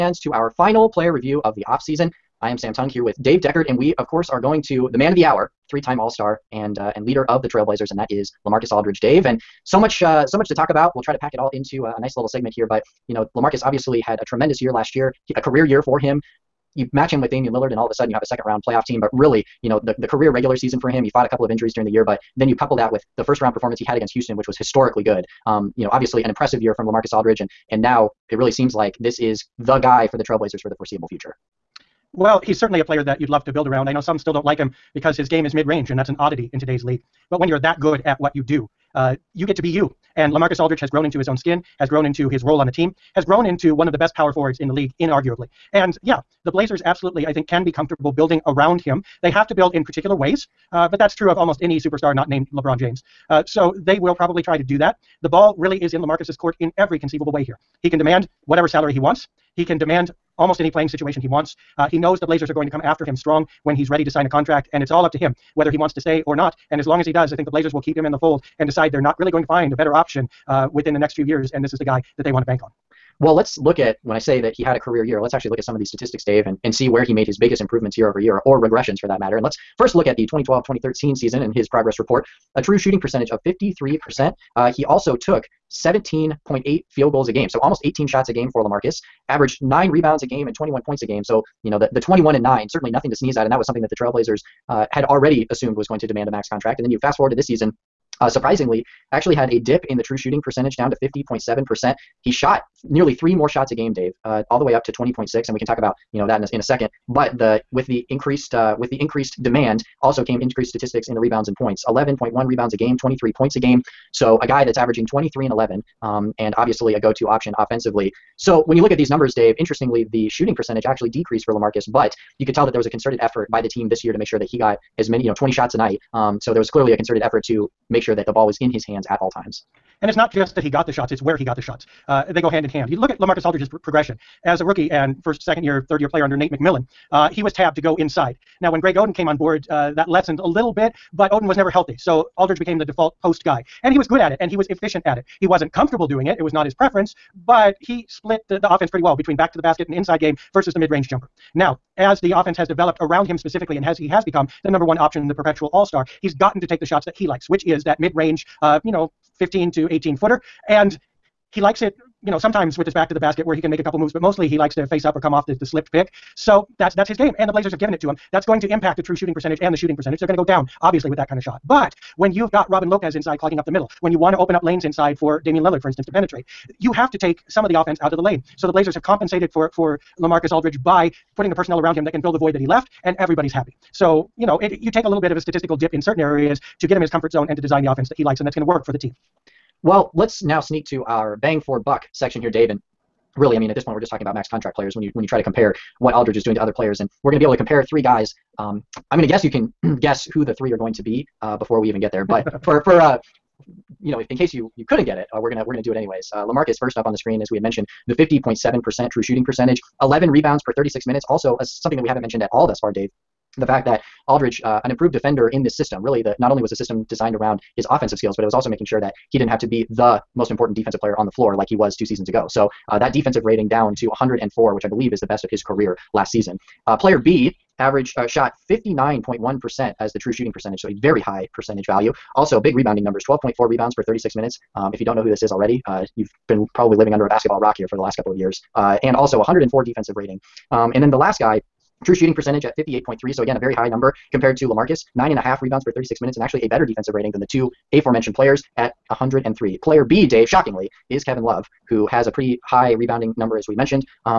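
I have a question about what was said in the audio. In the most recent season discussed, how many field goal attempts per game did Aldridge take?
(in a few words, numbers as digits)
20.6.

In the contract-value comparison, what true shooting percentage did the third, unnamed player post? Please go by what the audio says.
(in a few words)
58.3.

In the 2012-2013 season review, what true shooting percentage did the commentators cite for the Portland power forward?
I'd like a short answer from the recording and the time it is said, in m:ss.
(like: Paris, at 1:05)
53%, at 1:23.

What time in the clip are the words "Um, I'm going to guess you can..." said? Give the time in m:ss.
3:18.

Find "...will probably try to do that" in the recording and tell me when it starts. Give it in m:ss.
0:53.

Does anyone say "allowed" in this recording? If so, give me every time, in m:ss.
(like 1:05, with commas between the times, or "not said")
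not said.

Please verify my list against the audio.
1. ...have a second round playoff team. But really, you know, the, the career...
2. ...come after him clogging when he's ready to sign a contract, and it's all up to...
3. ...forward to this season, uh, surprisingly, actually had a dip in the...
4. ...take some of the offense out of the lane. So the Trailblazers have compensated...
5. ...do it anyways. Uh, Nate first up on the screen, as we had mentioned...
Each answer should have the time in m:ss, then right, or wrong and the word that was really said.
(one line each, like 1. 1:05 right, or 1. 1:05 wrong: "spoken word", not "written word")
1. 0:18 right
2. 1:02 wrong: "strong", not "clogging"
3. 1:37 right
4. 2:57 wrong: "Blazers", not "Trailblazers"
5. 3:25 wrong: "Lamarcus", not "Nate".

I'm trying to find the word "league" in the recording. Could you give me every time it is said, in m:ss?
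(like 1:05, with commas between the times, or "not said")
0:36, 0:44.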